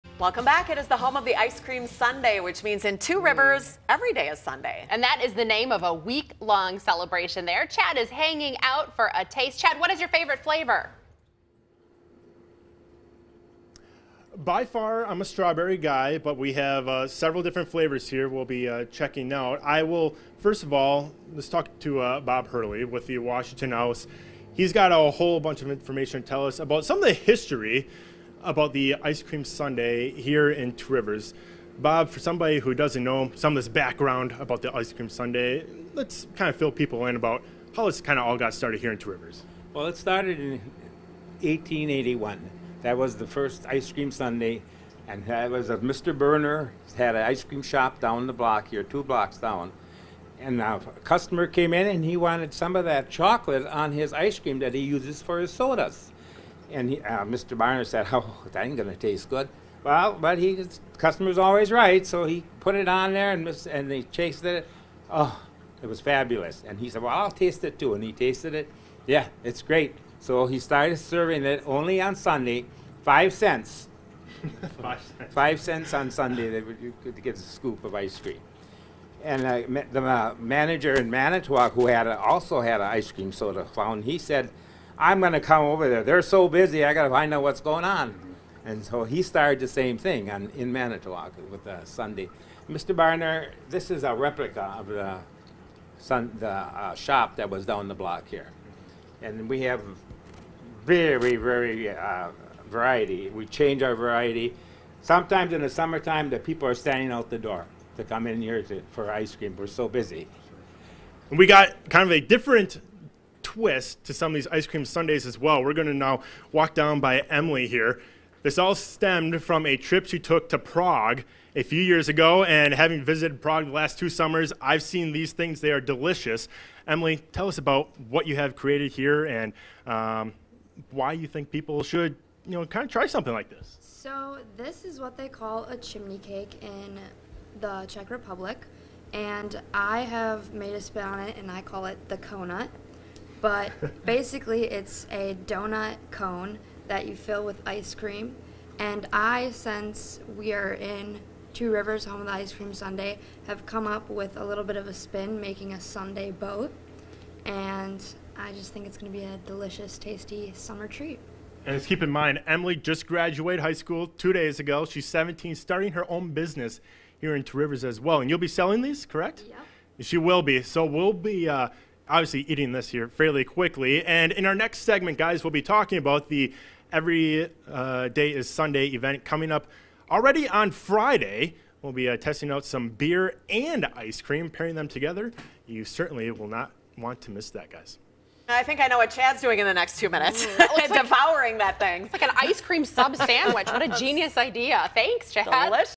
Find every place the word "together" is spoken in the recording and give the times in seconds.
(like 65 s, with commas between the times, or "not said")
184 s.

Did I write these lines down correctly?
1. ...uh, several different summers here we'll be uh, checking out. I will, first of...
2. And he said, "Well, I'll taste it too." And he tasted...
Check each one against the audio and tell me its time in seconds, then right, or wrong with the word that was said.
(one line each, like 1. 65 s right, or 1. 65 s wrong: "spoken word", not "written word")
1. 16 s wrong: "flavors", not "summers"
2. 66 s right.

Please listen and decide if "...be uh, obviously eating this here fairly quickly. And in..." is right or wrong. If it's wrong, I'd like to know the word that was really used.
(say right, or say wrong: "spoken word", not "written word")
right.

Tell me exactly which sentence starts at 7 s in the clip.
Chad is hanging out for a taste.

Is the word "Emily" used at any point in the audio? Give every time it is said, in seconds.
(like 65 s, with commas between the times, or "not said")
117 s, 126 s, 162 s.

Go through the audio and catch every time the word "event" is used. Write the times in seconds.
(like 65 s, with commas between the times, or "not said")
178 s.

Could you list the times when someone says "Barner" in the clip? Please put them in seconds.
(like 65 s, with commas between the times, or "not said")
57 s, 92 s.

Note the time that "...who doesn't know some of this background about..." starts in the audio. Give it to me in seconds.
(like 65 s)
32 s.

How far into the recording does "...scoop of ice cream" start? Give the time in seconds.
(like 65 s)
77 s.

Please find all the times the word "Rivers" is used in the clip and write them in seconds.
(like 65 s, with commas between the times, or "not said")
3 s, 30 s, 39 s, 151 s, 167 s.